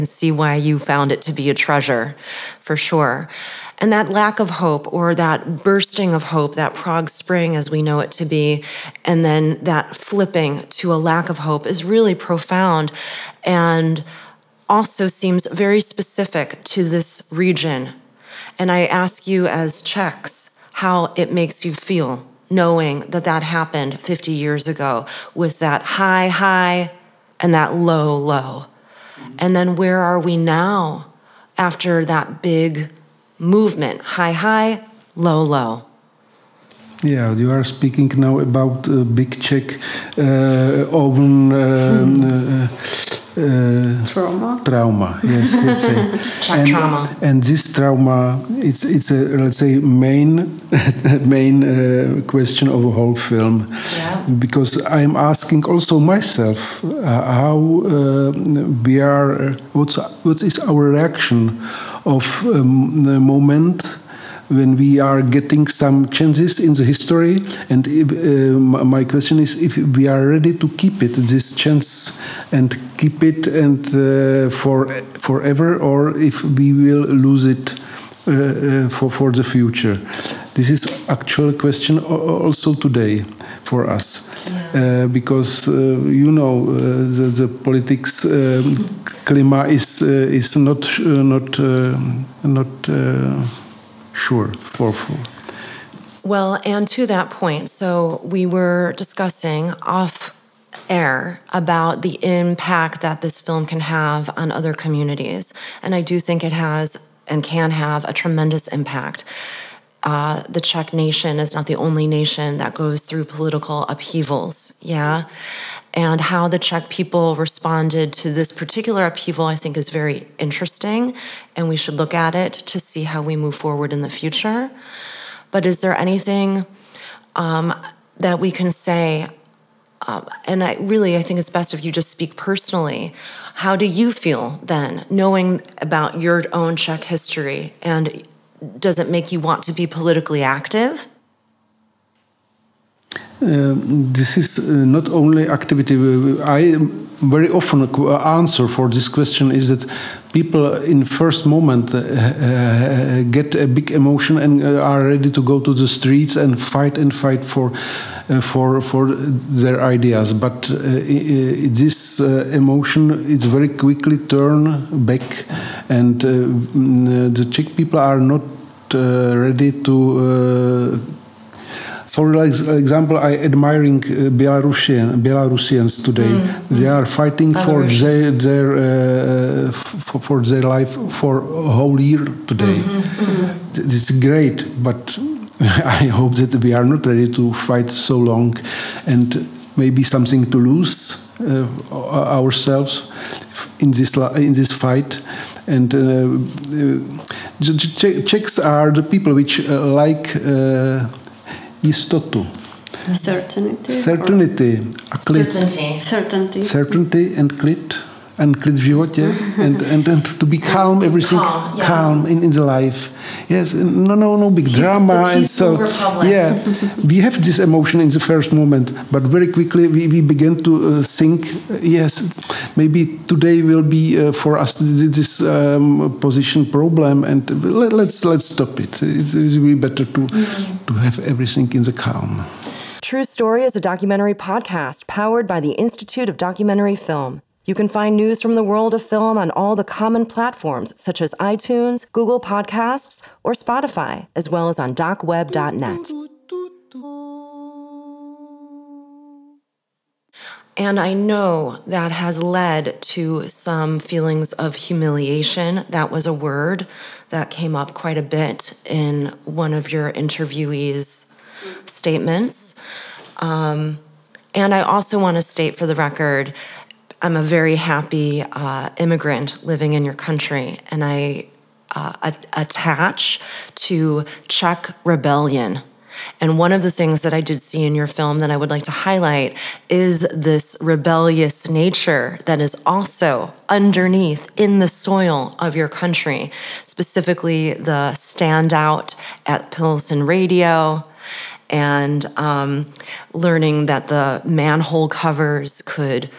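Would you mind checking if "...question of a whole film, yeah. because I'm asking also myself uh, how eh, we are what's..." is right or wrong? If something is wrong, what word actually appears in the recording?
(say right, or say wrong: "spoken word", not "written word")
right.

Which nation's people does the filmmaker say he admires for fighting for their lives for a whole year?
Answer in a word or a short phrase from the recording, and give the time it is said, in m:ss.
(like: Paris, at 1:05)
Belarusians, at 2:55.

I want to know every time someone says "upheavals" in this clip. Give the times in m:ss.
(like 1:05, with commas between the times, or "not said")
1:53, 1:59.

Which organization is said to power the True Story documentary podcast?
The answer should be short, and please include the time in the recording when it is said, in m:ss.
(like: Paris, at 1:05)
Institute of Documentary Film, at 3:55.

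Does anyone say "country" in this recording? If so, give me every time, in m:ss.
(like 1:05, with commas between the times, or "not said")
4:30, 4:45.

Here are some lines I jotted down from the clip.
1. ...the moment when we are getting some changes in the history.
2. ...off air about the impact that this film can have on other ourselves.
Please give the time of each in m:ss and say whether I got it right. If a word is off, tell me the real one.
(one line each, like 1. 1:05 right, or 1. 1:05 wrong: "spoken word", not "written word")
1. 1:03 right
2. 1:39 wrong: "communities", not "ourselves".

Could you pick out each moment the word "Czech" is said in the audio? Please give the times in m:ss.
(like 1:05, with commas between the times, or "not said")
0:19, 0:39, 1:50, 1:56, 2:16, 2:47, 3:18, 4:34.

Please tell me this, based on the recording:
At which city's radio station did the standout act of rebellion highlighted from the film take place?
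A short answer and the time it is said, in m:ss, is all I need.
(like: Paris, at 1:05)
Pilsen, at 4:49.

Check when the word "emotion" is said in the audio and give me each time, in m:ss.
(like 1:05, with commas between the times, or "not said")
2:33, 2:42, 3:37.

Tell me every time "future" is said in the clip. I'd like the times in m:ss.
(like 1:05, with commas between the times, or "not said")
1:19, 2:04.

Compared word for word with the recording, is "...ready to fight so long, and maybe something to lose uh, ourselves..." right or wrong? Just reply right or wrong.
right.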